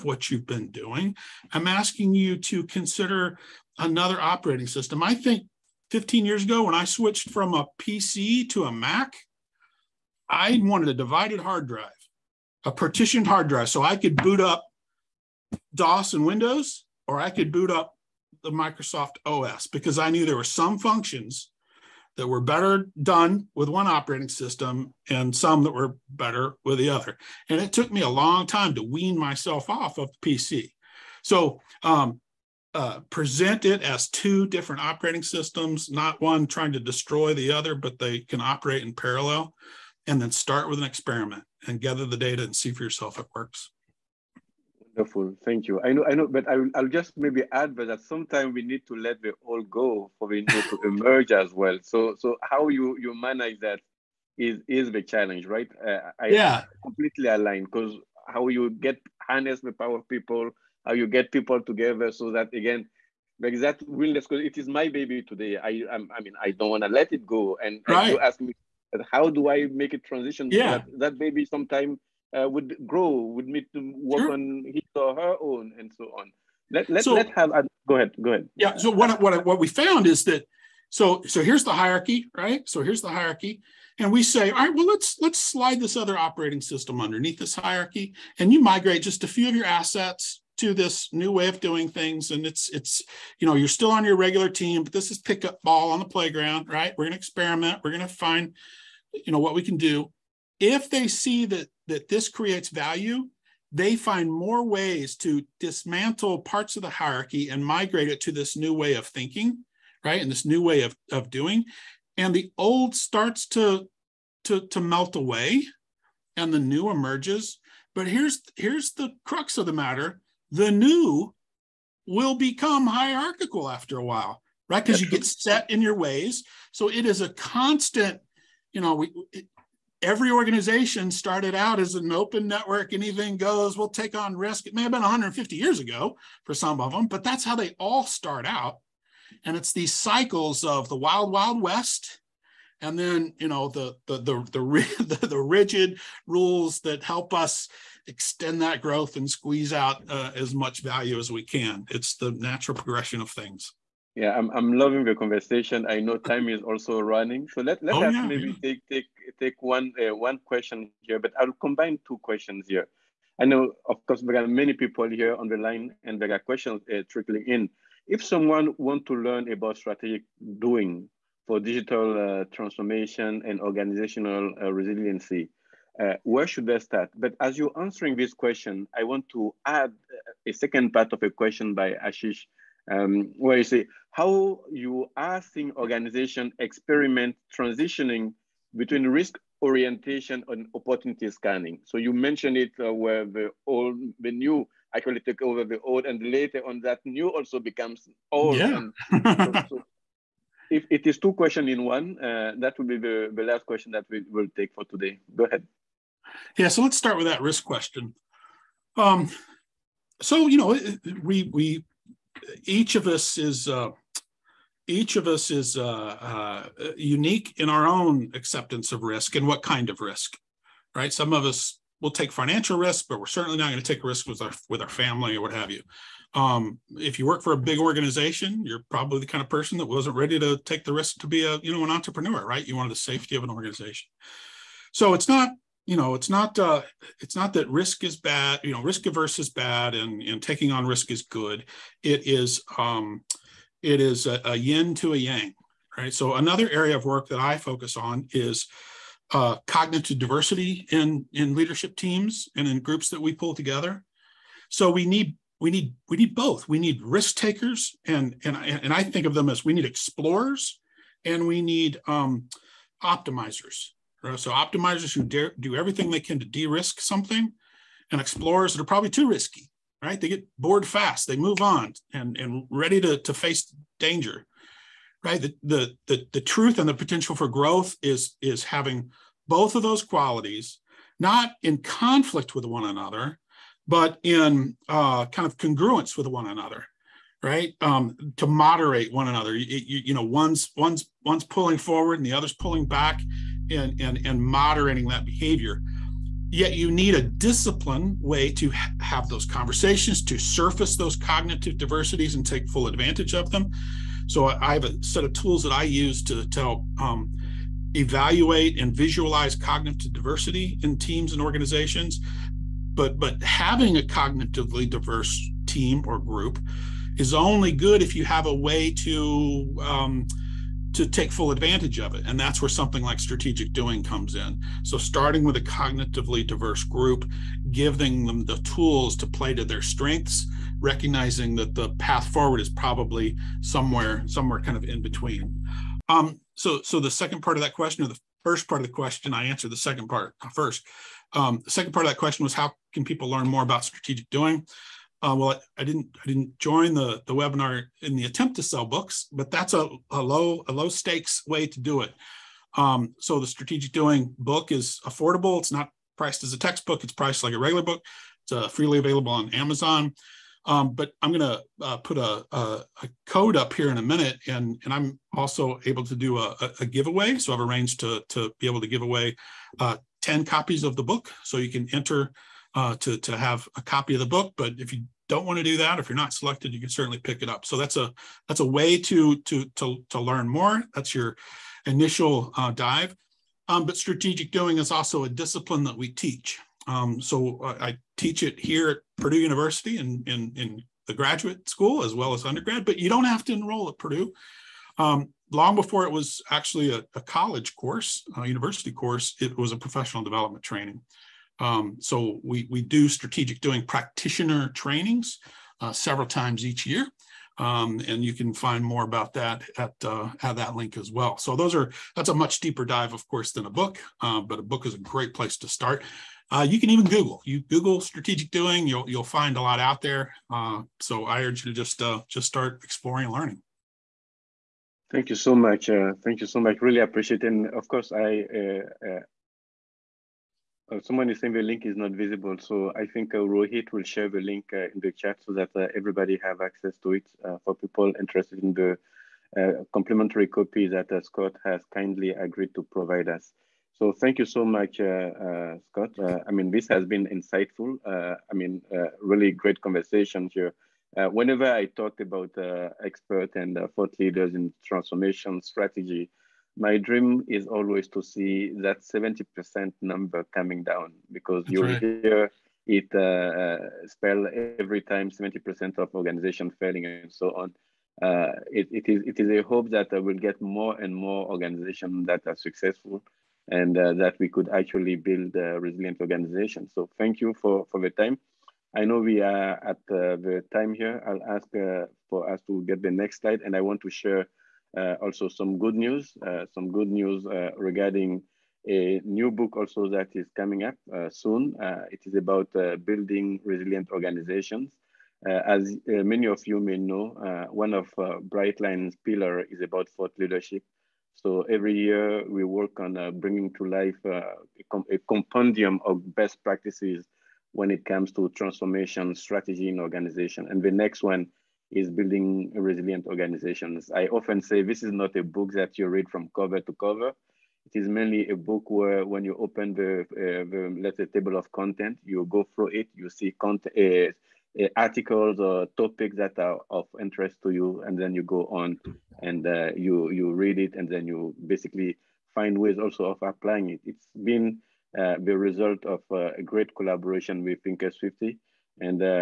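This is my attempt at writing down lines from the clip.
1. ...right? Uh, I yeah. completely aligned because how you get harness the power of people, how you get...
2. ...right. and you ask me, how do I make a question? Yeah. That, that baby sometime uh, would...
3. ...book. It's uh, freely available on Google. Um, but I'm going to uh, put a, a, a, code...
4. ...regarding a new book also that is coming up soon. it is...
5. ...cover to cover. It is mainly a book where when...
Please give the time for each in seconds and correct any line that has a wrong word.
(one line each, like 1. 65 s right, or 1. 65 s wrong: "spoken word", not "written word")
1. 55 s right
2. 67 s wrong: "transition", not "question"
3. 357 s wrong: "Amazon", not "Google"
4. 487 s right
5. 516 s right.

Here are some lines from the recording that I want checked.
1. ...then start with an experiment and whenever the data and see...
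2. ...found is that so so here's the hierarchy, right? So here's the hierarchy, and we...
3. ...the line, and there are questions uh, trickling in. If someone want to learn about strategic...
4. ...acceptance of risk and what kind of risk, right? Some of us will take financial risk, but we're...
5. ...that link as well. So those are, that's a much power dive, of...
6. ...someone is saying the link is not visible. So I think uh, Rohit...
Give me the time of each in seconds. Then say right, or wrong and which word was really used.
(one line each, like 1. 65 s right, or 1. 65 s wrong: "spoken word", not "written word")
1. 40 s wrong: "gather", not "whenever"
2. 79 s right
3. 165 s right
4. 218 s right
5. 410 s wrong: "deeper", not "power"
6. 431 s right.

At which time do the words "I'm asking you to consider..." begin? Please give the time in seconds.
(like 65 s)
1 s.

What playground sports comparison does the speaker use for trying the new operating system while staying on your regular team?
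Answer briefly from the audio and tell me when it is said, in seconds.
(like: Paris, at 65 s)
pickup ball, at 95 s.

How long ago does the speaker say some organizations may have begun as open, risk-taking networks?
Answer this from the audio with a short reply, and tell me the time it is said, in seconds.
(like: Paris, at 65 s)
150 years ago, at 135 s.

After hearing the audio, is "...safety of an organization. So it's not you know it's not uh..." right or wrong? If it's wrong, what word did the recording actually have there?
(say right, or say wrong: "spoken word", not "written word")
right.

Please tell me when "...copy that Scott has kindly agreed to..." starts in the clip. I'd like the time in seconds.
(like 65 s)
440 s.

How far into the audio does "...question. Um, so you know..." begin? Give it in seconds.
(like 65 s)
207 s.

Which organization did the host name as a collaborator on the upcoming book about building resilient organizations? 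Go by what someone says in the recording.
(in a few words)
Thinkers 50.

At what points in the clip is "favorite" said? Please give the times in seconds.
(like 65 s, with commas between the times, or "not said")
not said.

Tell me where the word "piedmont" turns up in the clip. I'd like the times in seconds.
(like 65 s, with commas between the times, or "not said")
not said.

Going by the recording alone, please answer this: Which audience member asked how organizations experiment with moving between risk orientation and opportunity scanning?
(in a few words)
Ashish.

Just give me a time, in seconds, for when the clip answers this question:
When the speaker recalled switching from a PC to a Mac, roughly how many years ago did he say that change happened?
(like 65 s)
5 s.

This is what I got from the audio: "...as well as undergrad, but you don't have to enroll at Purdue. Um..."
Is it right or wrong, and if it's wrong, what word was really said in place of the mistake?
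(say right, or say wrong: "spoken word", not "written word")
right.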